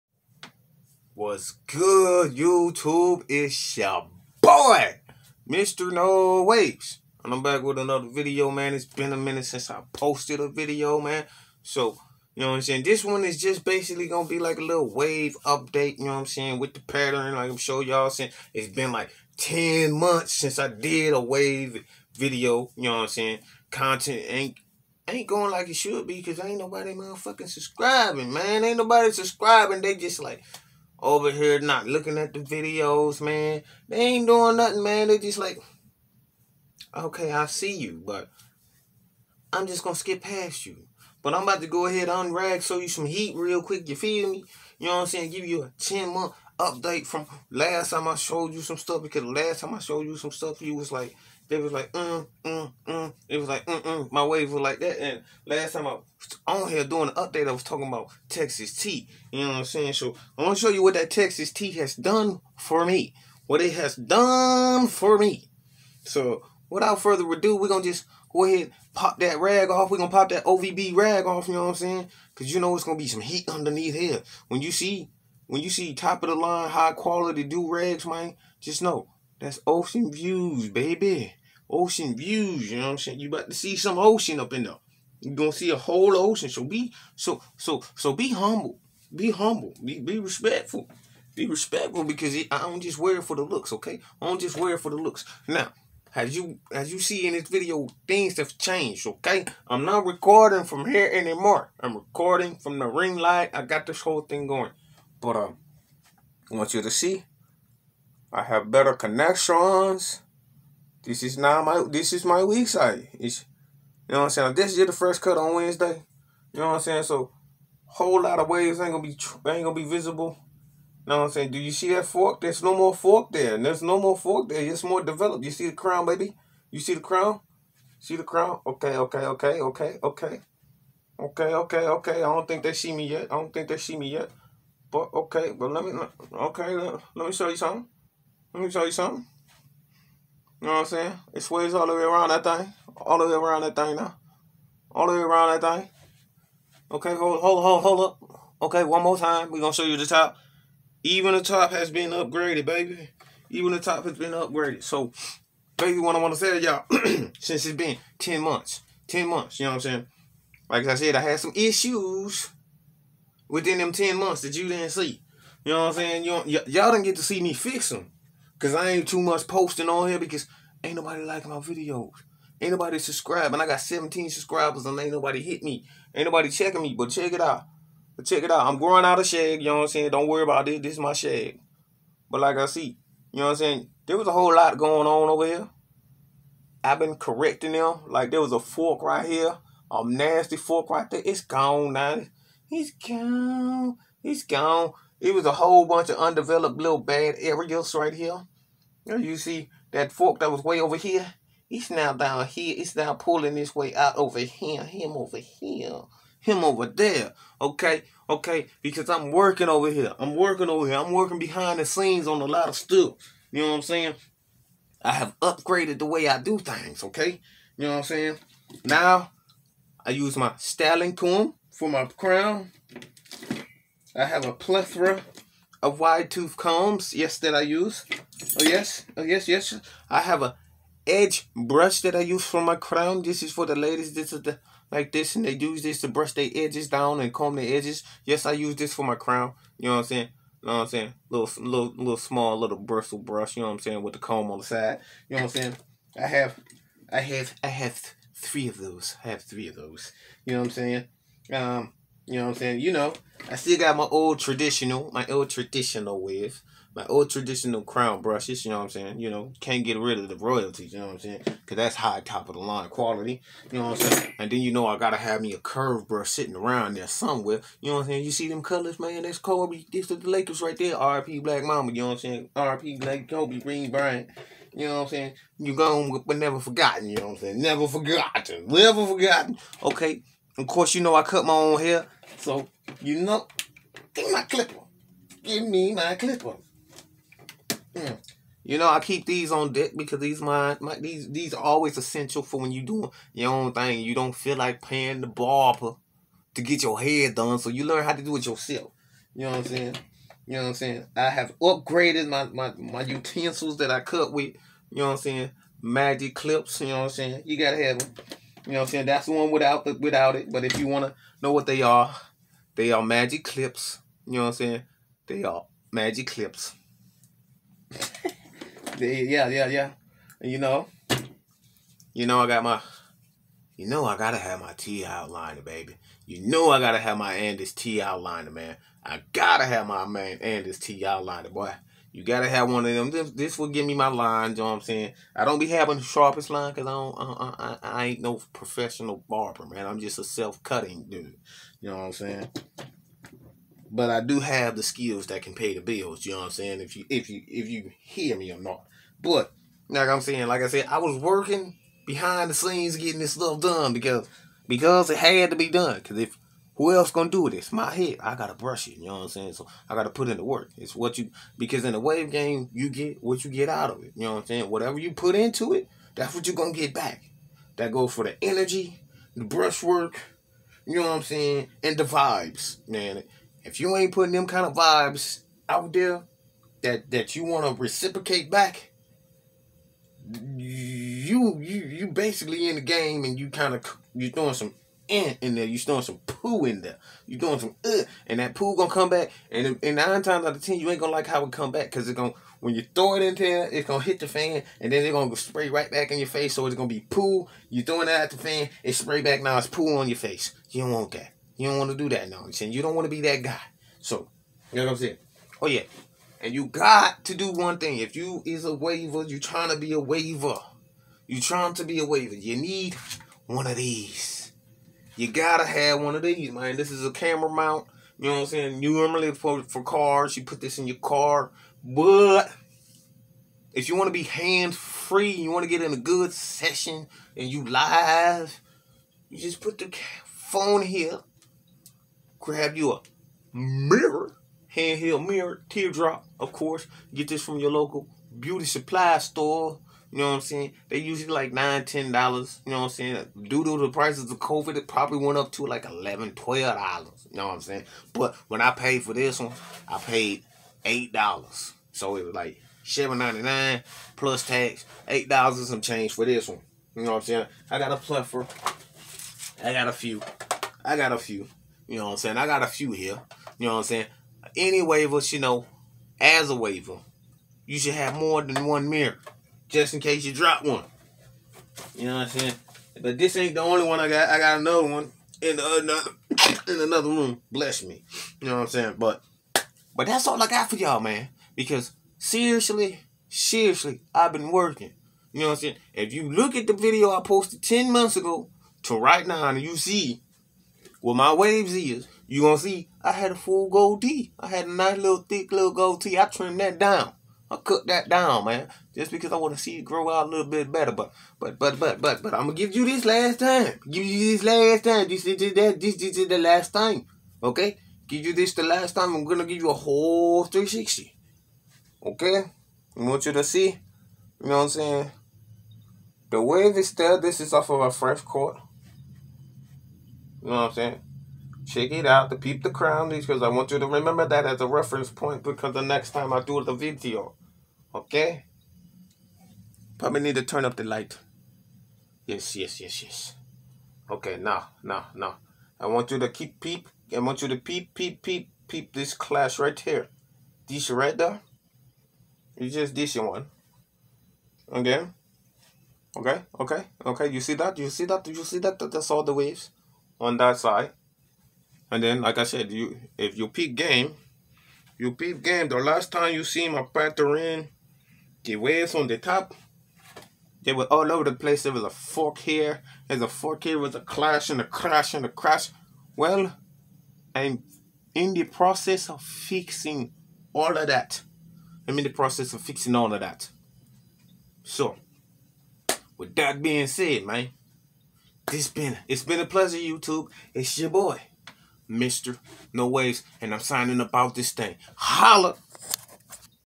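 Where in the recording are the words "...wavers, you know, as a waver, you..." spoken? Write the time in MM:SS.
07:44.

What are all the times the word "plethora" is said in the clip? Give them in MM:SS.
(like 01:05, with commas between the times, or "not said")
03:44, 07:37.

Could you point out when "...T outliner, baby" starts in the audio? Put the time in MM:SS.
05:24.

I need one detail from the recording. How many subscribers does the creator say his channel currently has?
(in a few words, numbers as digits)
17.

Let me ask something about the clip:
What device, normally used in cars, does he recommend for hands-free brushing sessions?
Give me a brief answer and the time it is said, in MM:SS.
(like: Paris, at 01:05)
Camera mount, at 06:57.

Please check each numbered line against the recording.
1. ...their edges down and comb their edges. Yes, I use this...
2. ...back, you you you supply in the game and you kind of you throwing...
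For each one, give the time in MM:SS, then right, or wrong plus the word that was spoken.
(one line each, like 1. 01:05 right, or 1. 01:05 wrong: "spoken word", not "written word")
1. 03:56 right
2. 06:18 wrong: "basically", not "supply".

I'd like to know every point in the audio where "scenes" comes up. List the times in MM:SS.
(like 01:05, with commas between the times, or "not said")
03:31, 05:52.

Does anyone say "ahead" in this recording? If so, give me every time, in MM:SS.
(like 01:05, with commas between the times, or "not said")
00:41, 01:08.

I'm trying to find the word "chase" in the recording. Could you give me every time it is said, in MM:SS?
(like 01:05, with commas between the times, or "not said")
not said.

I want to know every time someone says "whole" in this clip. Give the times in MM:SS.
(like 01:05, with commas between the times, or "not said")
01:25, 01:44, 01:57, 03:04, 03:15, 08:29.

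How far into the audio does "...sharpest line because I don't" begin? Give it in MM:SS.
05:36.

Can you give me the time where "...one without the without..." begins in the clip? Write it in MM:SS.
05:09.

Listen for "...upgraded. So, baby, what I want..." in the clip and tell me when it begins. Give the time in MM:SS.
02:34.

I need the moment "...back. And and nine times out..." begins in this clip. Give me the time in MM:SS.
06:29.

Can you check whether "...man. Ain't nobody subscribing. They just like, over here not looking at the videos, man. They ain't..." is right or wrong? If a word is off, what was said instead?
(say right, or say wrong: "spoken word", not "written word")
right.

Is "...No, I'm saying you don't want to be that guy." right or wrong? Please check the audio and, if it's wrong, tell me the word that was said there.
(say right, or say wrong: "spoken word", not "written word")
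right.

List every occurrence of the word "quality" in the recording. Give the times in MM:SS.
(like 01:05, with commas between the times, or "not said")
01:16, 04:22.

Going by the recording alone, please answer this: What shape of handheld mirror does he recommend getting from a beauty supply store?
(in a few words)
Teardrop.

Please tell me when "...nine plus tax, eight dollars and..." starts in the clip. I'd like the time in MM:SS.
07:33.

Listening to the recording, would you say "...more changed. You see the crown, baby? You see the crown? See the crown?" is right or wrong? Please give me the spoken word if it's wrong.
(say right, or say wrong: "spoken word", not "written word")
wrong: "developed", not "changed".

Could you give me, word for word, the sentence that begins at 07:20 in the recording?
They usually like nine, ten dollars.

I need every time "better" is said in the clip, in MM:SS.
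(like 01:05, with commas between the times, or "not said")
01:48, 08:20.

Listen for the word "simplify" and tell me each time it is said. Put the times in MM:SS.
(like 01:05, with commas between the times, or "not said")
not said.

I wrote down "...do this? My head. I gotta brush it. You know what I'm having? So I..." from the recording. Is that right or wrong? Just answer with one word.
wrong.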